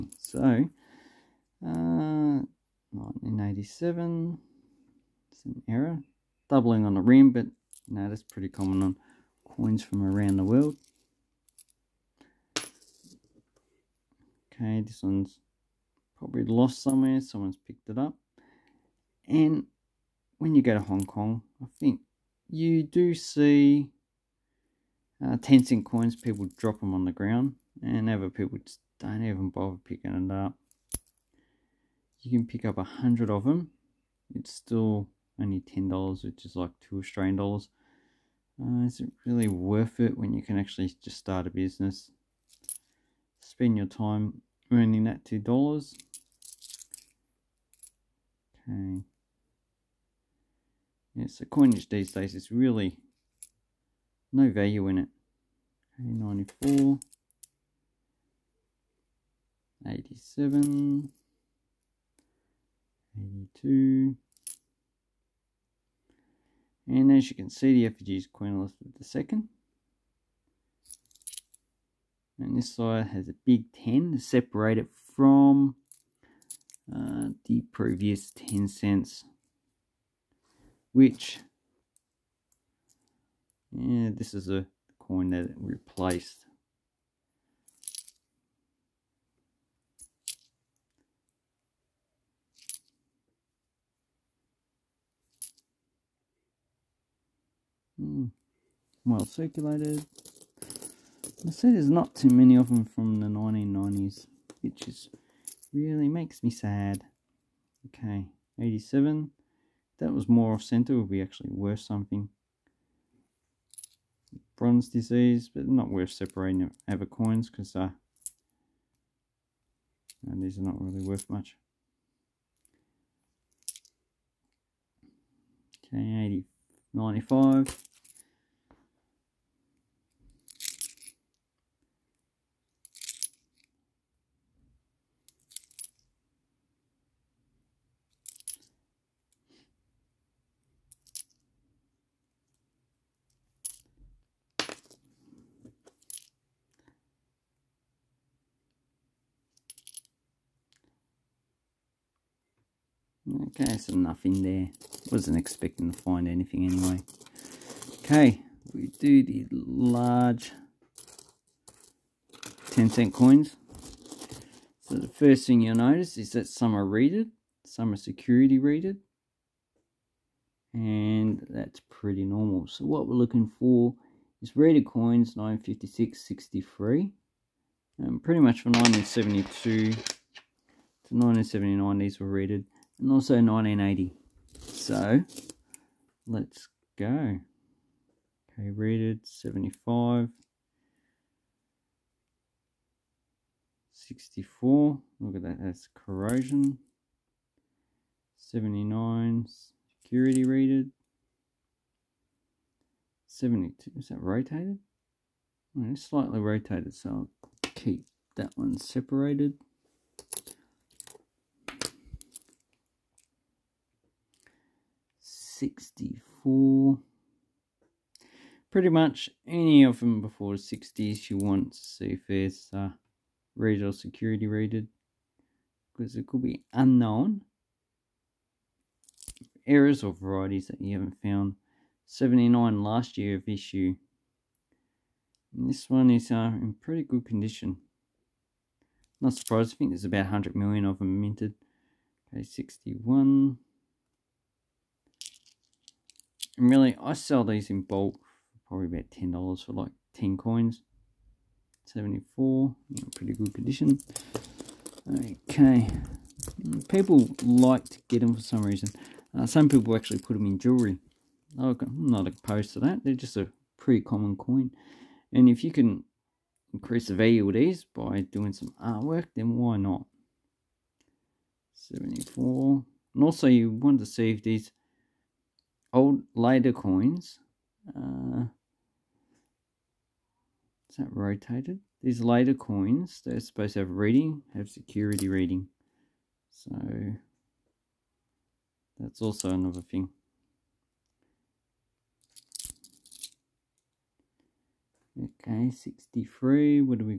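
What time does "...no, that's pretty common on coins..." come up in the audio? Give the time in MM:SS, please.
00:07.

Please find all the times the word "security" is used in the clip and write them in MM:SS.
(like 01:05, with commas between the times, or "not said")
02:47, 03:20, 03:43, 04:44.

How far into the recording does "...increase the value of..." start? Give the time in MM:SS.
04:26.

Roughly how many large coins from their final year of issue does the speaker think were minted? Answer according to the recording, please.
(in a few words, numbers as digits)
100 million.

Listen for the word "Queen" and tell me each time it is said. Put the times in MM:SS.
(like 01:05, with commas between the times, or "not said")
01:08.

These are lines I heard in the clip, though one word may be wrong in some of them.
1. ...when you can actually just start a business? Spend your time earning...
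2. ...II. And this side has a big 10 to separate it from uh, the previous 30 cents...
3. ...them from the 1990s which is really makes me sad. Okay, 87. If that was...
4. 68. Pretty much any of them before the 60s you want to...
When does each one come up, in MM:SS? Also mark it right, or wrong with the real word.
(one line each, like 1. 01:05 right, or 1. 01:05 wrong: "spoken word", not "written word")
1. 00:40 right
2. 01:09 wrong: "10", not "30"
3. 01:42 right
4. 03:35 wrong: "64", not "68".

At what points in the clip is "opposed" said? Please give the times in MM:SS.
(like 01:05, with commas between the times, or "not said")
04:22.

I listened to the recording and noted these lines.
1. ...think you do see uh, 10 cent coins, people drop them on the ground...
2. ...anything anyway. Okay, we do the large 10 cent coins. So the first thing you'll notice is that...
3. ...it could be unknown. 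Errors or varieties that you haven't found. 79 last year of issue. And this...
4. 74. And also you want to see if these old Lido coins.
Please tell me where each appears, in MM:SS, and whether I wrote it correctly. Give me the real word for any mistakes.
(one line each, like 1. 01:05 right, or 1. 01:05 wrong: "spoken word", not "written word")
1. 00:21 right
2. 02:36 right
3. 03:46 right
4. 04:31 right.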